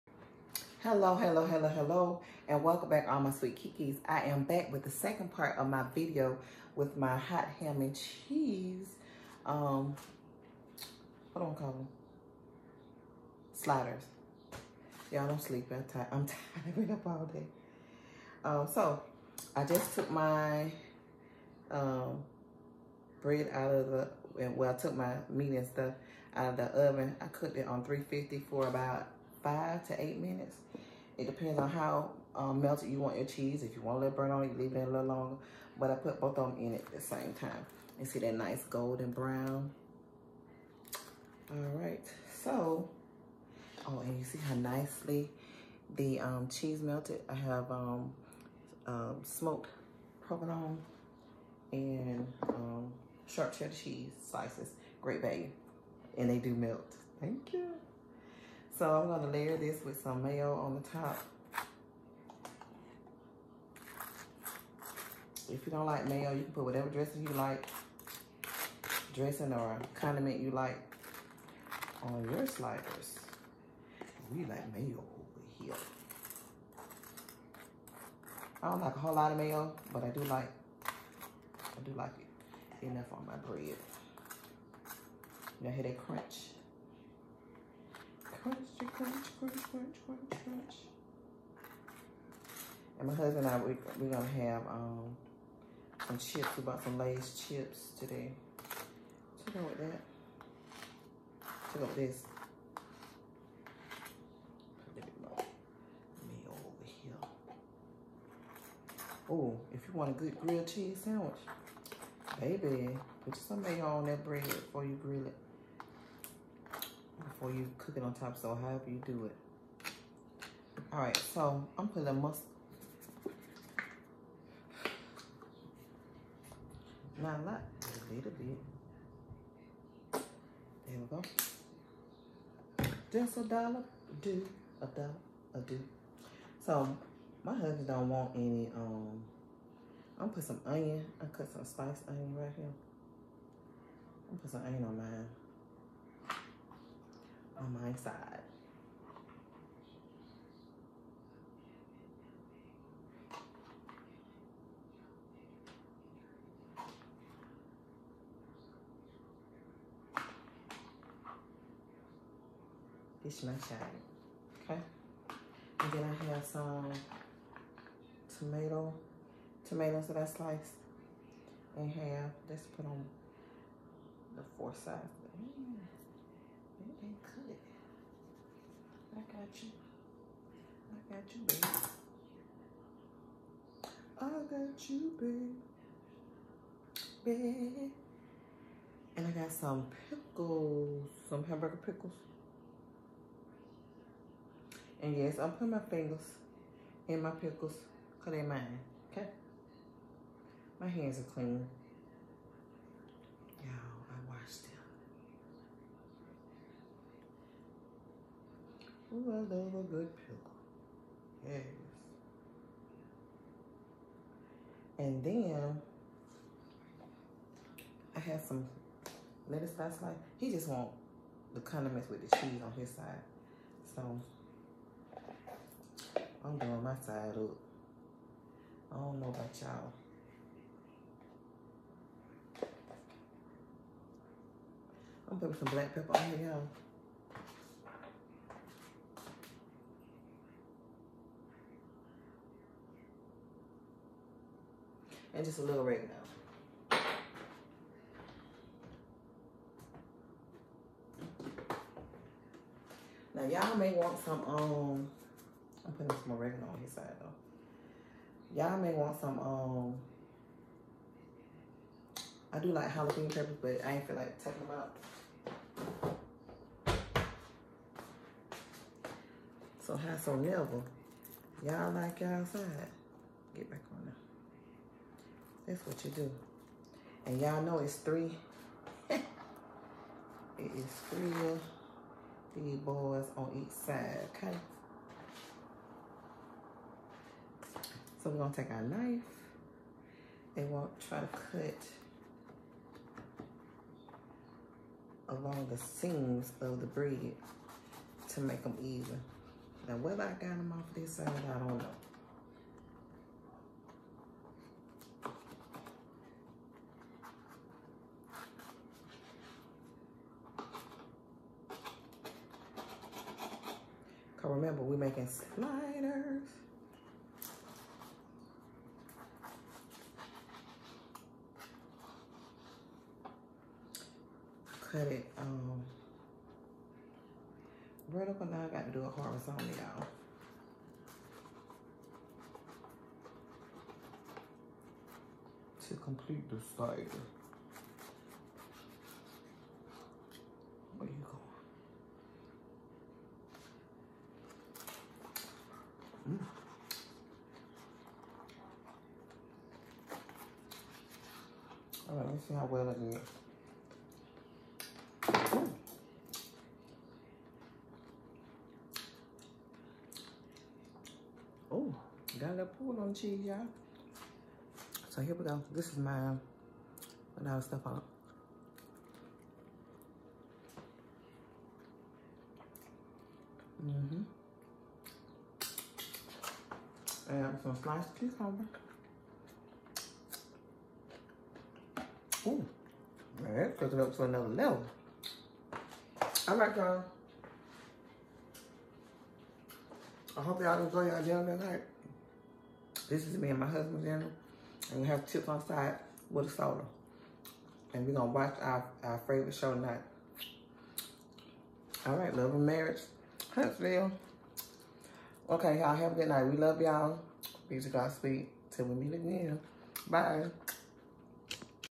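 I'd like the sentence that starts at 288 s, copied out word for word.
So we're gonna take our knife and we'll try to cut along the seams of the bread to make them even.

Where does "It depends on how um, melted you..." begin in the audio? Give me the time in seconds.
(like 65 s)
31 s.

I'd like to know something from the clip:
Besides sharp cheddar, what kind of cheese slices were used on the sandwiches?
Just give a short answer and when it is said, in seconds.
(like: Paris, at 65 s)
smoked provolone, at 49 s.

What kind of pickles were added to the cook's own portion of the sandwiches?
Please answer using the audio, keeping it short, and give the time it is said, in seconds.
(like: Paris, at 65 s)
hamburger pickles, at 191 s.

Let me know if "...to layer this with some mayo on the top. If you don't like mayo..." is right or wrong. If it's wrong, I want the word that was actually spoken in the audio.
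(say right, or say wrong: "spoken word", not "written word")
right.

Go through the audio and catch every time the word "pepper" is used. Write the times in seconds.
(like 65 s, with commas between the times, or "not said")
235 s, 263 s.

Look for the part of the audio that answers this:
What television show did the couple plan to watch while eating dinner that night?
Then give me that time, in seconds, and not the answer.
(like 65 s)
402 s.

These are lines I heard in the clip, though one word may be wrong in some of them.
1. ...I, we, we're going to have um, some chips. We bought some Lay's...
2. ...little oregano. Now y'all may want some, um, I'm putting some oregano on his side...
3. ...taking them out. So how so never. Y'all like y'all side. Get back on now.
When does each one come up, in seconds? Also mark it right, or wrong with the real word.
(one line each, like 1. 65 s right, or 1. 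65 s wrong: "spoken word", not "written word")
1. 93 s right
2. 245 s right
3. 264 s right.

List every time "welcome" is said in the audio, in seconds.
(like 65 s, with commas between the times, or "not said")
2 s.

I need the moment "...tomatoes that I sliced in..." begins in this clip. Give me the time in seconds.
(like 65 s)
169 s.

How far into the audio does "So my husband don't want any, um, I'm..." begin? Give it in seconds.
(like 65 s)
136 s.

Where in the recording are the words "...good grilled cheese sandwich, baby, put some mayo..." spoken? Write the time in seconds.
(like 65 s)
110 s.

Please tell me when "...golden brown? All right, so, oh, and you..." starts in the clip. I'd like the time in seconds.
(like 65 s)
38 s.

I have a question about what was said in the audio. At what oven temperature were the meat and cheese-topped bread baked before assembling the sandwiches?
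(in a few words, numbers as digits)
350.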